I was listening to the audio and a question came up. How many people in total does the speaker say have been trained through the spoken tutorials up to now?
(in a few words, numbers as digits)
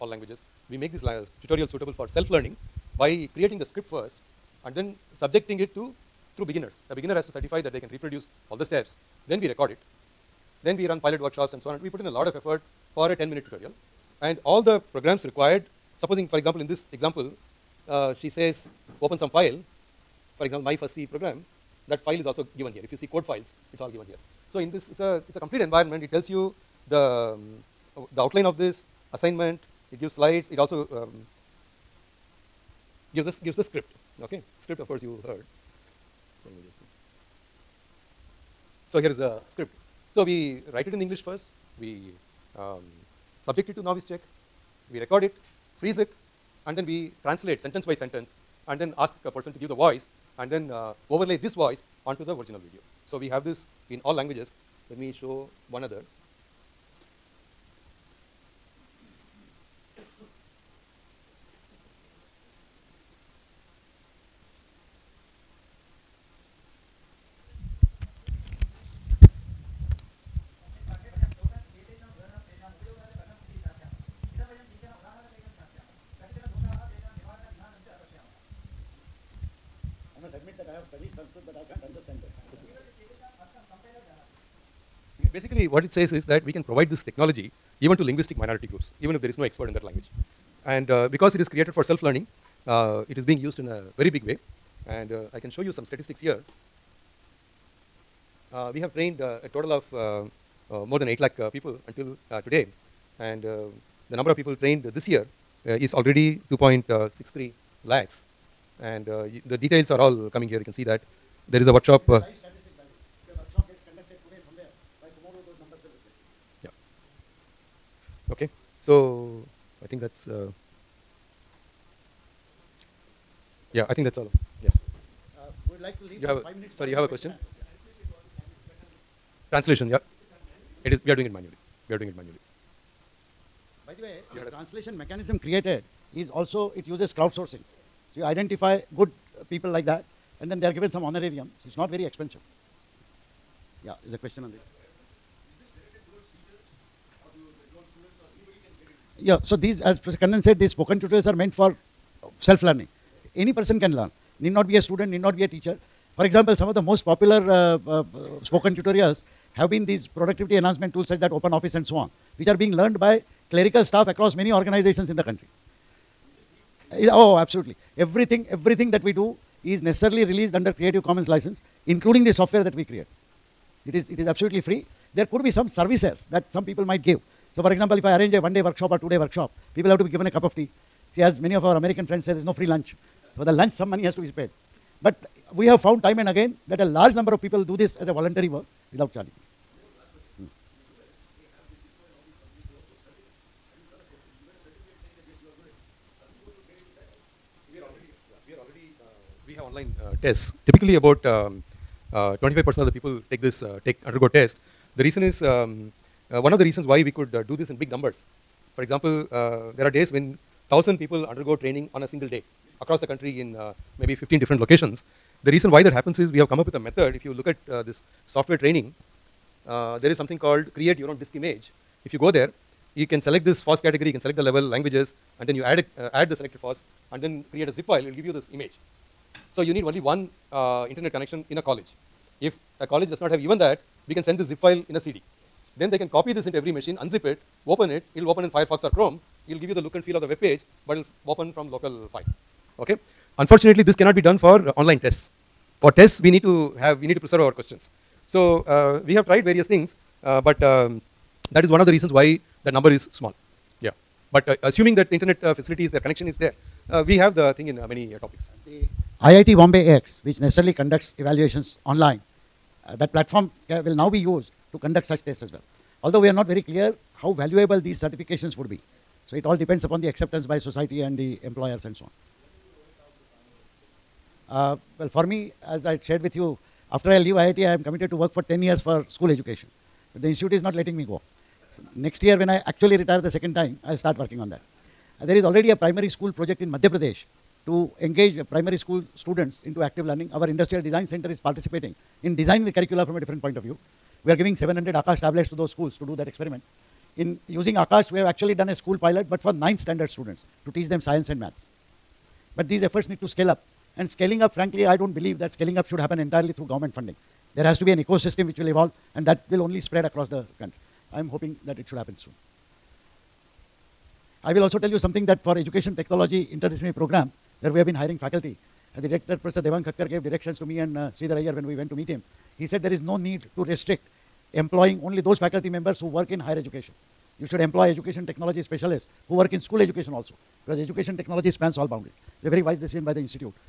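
more than 8 lakh.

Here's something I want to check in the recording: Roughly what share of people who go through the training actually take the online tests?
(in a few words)
25%.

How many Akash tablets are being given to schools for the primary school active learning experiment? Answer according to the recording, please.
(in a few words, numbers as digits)
700.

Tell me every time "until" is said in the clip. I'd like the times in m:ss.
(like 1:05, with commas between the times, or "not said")
1:41.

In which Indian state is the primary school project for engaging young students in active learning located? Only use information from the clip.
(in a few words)
Madhya Pradesh.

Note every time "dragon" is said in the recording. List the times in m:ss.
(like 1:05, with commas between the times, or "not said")
not said.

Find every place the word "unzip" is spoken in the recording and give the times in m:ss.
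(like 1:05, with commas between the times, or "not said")
3:56.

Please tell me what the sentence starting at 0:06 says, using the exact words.
The beginner has to certify that they can reproduce all the steps.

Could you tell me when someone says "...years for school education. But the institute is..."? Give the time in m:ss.
4:38.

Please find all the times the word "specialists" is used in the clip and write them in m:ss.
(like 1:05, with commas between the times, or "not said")
5:28.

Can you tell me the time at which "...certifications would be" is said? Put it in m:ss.
4:27.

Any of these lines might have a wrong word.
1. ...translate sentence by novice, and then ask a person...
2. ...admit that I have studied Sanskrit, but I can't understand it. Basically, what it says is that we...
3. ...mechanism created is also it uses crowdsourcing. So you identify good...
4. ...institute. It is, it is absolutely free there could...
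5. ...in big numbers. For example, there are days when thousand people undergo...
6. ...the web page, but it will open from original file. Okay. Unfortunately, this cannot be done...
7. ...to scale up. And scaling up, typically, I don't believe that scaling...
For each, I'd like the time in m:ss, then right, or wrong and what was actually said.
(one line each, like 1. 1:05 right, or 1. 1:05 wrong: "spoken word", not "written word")
1. 0:47 wrong: "sentence", not "novice"
2. 1:20 right
3. 2:14 right
4. 2:52 wrong: "create", not "institute"
5. 3:27 right
6. 4:00 wrong: "local", not "original"
7. 5:03 wrong: "frankly", not "typically".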